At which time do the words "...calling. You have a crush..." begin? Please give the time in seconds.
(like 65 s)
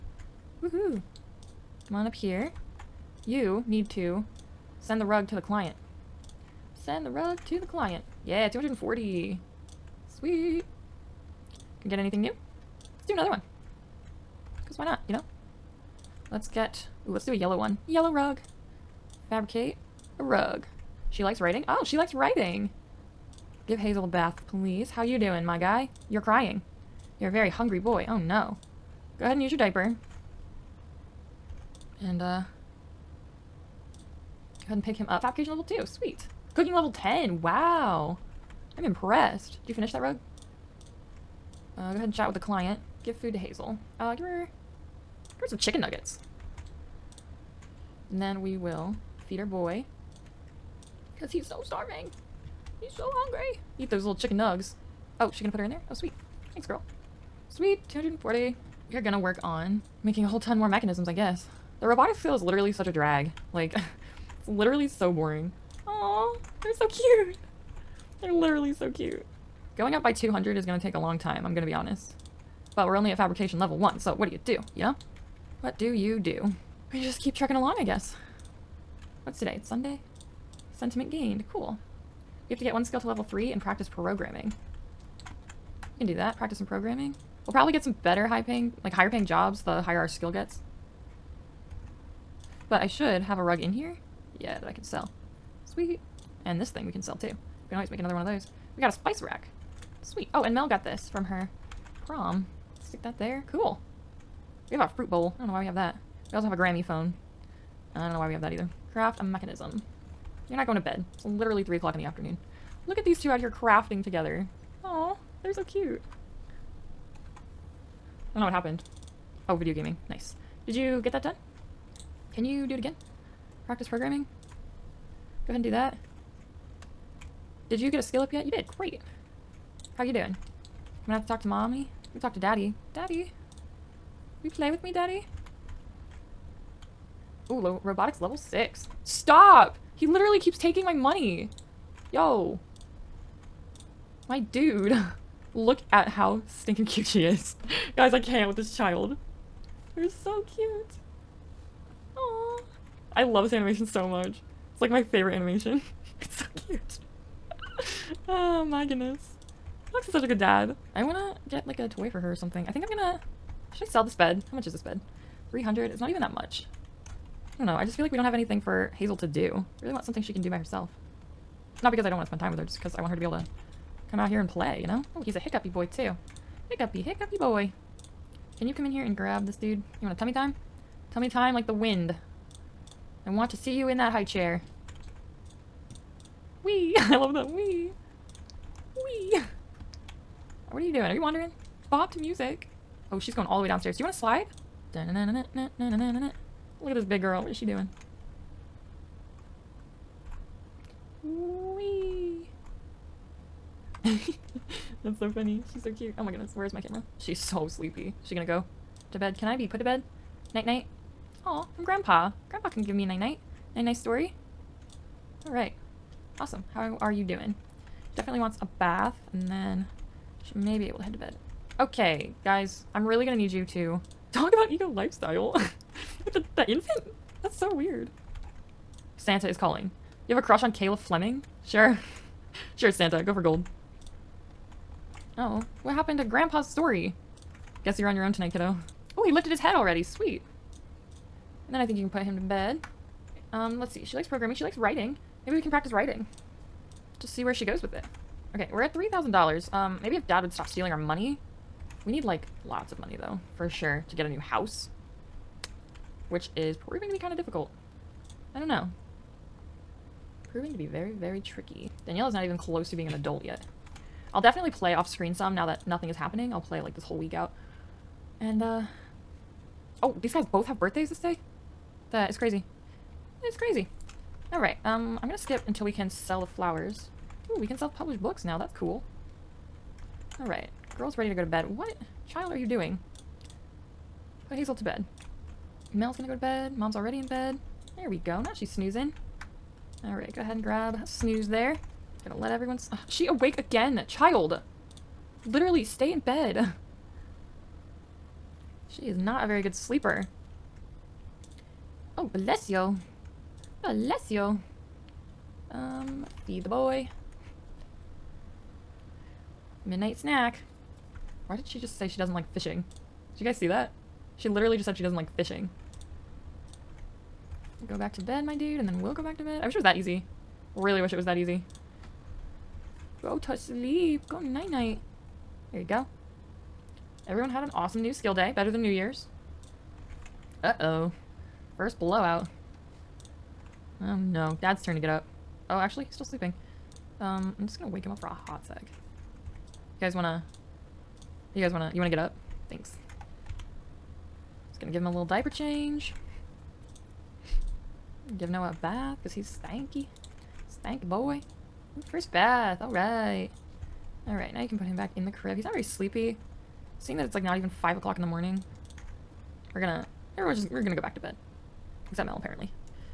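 229 s.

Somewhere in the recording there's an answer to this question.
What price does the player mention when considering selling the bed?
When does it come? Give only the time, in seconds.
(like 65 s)
165 s.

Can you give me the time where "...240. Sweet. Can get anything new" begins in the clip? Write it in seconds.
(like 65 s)
8 s.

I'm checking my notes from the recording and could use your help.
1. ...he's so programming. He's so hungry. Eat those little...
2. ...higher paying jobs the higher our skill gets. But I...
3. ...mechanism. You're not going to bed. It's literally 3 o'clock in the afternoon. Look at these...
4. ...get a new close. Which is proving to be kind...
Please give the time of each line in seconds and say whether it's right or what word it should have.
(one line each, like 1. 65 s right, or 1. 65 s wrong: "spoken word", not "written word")
1. 51 s wrong: "starving", not "programming"
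2. 88 s right
3. 109 s right
4. 254 s wrong: "house", not "close".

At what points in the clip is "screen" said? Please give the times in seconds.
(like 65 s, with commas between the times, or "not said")
265 s.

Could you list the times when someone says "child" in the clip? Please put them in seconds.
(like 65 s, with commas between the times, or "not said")
148 s, 282 s, 294 s.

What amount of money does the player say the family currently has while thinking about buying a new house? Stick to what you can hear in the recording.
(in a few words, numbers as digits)
$3,000.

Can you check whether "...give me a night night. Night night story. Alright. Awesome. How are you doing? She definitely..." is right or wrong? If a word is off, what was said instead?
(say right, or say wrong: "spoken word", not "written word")
right.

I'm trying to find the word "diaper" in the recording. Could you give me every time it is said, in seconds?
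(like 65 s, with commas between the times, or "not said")
29 s, 345 s.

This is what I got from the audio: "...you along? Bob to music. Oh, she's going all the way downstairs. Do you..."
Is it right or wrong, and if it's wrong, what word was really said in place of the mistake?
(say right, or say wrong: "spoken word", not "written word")
wrong: "wandering", not "along".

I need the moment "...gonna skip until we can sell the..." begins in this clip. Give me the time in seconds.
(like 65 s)
275 s.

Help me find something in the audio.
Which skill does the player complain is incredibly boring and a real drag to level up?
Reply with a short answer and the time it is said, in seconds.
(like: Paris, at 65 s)
Robotics, at 61 s.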